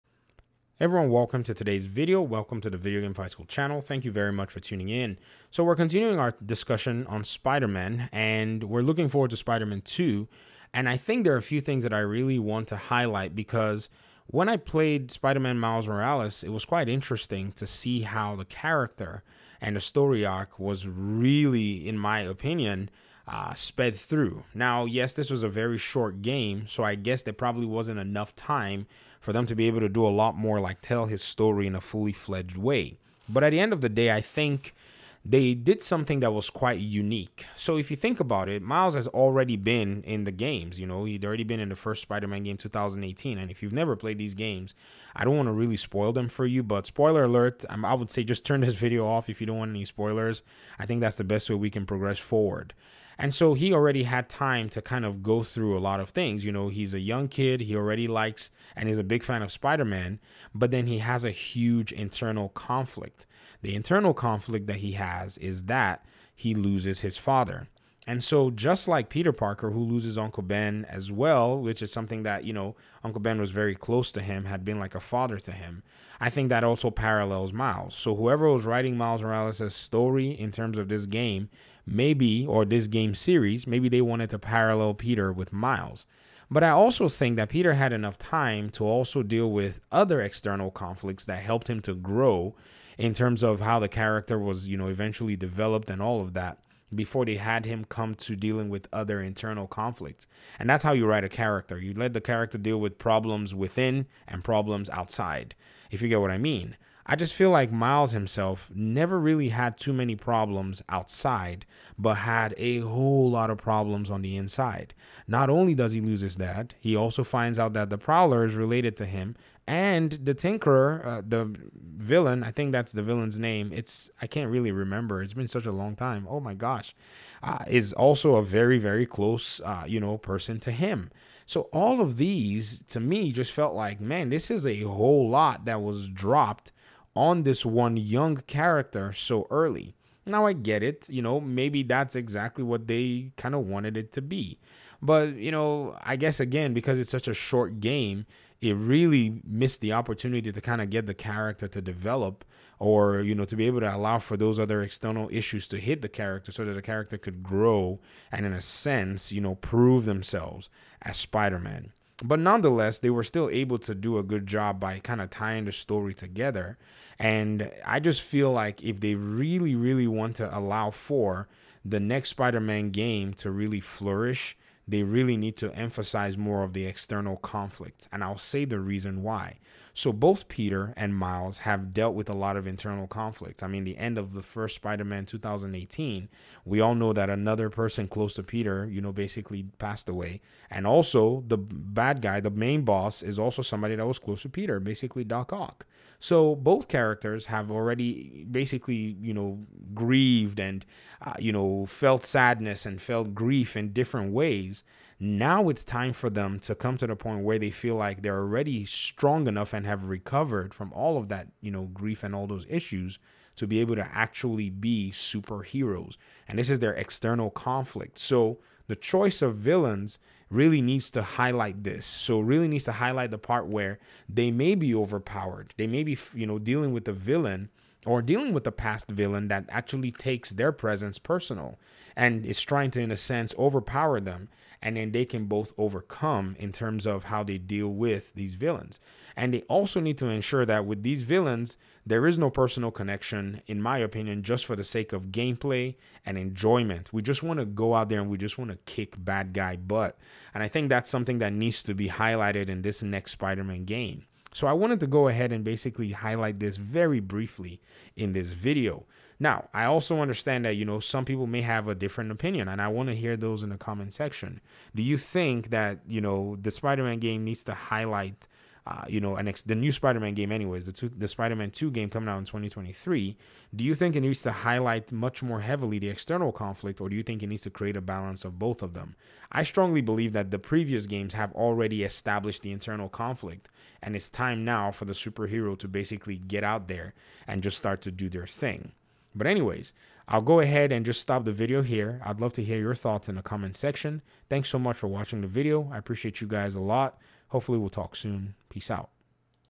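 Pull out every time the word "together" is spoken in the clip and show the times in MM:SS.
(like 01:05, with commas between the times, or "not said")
02:46.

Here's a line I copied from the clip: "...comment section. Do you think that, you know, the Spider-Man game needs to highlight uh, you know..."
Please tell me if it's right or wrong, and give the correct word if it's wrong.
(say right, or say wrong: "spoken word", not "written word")
right.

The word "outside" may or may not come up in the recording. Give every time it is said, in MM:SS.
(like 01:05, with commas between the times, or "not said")
01:44, 01:50.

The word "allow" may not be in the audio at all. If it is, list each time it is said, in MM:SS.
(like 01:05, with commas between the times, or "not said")
02:33, 02:50.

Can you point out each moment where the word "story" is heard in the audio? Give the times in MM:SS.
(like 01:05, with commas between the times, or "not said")
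00:19, 00:31, 01:19, 02:45.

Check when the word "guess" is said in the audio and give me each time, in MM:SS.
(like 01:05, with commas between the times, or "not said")
00:26, 02:26.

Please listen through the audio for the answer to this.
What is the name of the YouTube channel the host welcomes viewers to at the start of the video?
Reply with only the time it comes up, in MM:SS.
00:02.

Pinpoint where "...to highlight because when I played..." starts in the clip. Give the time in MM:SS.
00:12.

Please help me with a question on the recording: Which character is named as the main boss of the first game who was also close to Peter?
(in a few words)
Doc Ock.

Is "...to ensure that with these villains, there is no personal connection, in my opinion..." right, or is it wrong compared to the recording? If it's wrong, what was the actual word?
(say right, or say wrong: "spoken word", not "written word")
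right.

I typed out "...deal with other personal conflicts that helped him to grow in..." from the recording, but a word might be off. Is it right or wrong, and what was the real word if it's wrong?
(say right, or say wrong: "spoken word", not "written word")
wrong: "external", not "personal".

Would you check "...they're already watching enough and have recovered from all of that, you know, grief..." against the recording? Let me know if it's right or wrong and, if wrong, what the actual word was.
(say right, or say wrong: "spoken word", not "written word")
wrong: "strong", not "watching".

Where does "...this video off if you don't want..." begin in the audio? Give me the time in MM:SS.
00:48.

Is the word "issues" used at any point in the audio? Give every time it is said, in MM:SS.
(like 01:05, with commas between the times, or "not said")
02:35, 03:32.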